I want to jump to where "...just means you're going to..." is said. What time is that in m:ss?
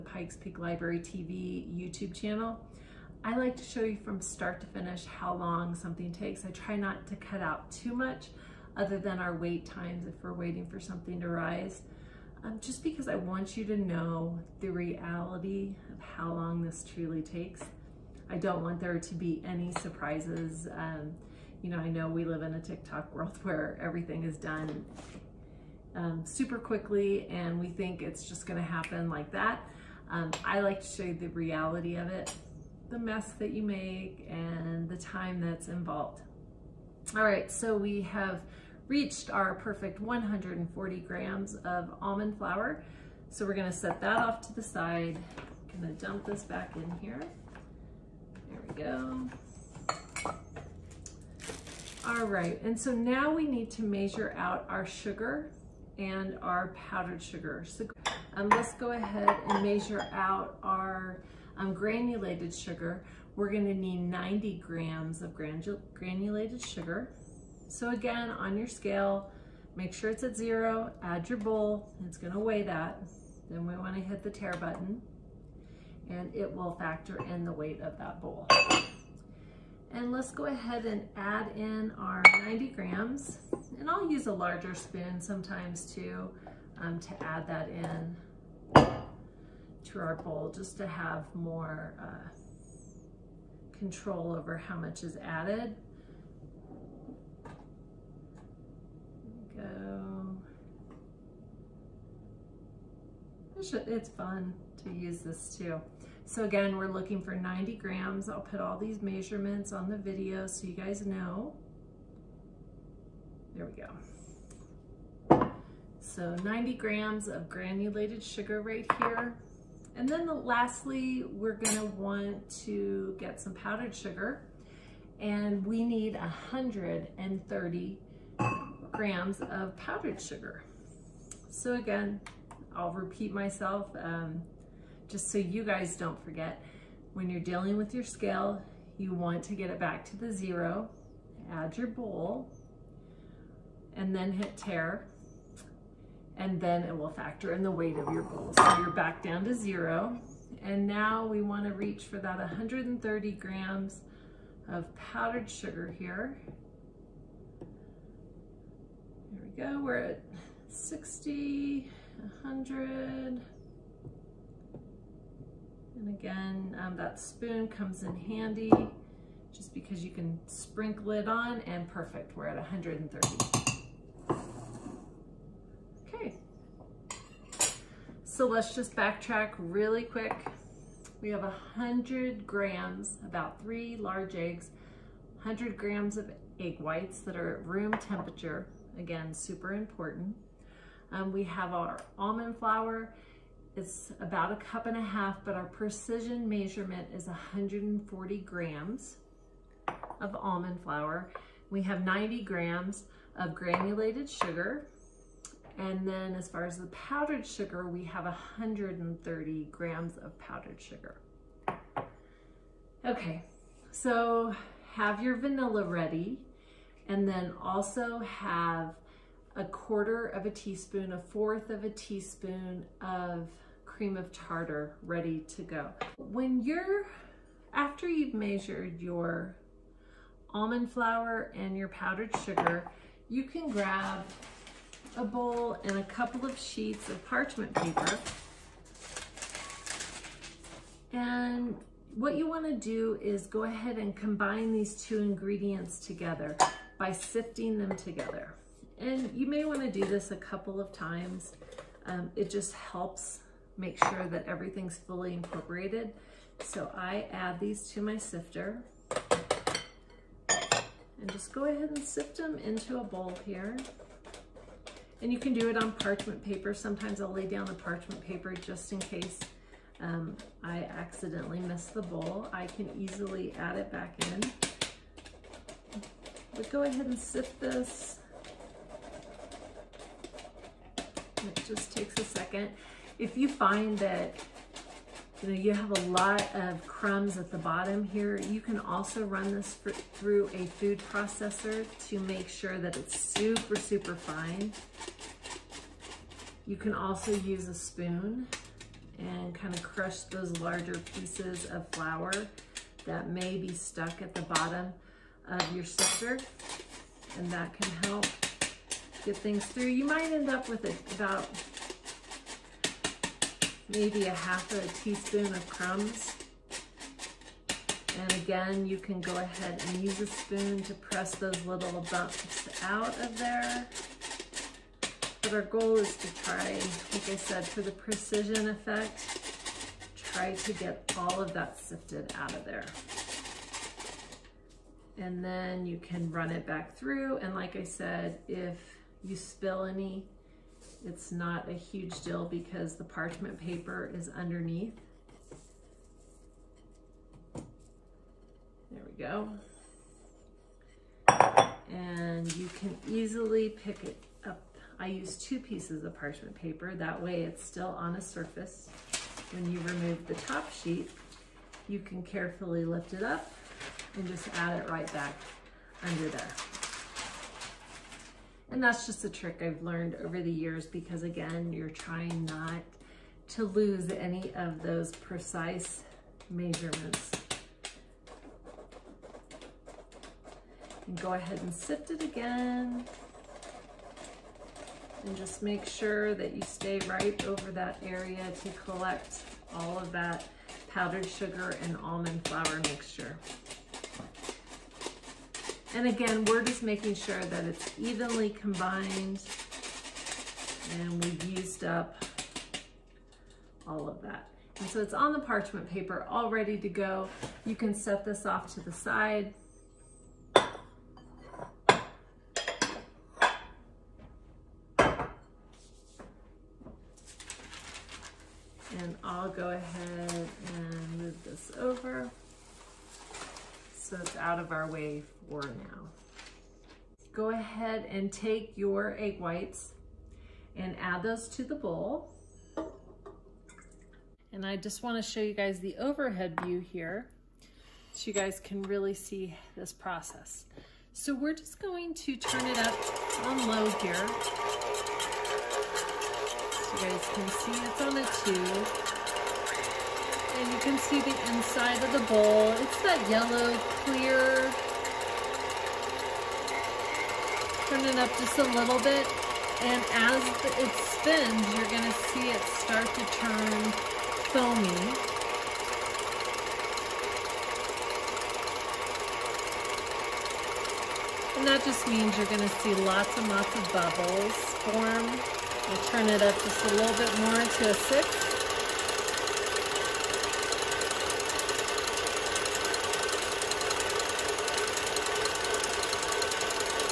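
7:51.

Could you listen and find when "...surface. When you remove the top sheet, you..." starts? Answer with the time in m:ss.
5:58.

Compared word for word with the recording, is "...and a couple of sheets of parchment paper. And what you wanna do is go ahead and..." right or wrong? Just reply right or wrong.
right.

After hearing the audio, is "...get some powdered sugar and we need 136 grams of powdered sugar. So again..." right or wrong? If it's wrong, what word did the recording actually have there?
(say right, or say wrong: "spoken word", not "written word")
wrong: "130", not "136".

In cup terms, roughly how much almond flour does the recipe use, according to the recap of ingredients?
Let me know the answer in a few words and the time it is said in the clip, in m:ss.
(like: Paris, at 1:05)
a cup and a half, at 3:14.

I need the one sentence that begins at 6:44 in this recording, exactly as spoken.
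And so it's on the parchment paper all ready to go.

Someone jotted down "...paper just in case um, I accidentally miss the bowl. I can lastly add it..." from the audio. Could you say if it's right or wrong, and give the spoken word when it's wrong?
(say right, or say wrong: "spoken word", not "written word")
wrong: "easily", not "lastly".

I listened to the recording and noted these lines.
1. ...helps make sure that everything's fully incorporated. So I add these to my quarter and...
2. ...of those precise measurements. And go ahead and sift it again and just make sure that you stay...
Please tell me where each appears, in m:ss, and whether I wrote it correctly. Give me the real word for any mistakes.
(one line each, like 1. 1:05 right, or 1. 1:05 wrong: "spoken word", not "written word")
1. 4:12 wrong: "sifter", not "quarter"
2. 6:14 right.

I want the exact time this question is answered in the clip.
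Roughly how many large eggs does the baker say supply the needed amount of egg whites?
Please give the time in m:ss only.
3:03.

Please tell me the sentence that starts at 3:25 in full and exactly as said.
And then as far as the powdered sugar, we have 130 grams of powdered sugar.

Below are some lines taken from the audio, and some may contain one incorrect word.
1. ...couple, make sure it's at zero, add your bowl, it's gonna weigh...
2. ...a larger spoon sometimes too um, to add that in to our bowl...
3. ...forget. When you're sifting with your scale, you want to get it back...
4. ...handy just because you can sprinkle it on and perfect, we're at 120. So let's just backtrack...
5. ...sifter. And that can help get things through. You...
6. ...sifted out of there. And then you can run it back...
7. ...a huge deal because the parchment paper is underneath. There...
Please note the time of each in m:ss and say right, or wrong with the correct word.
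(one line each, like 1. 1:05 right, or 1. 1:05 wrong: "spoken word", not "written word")
1. 1:08 wrong: "scale", not "couple"
2. 1:24 right
3. 2:16 wrong: "dealing", not "sifting"
4. 2:48 wrong: "130", not "120"
5. 5:05 right
6. 5:31 right
7. 5:41 right.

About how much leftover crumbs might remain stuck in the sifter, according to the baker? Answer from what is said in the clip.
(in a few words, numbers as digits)
half a teaspoon.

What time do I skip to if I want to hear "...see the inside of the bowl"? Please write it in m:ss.
7:30.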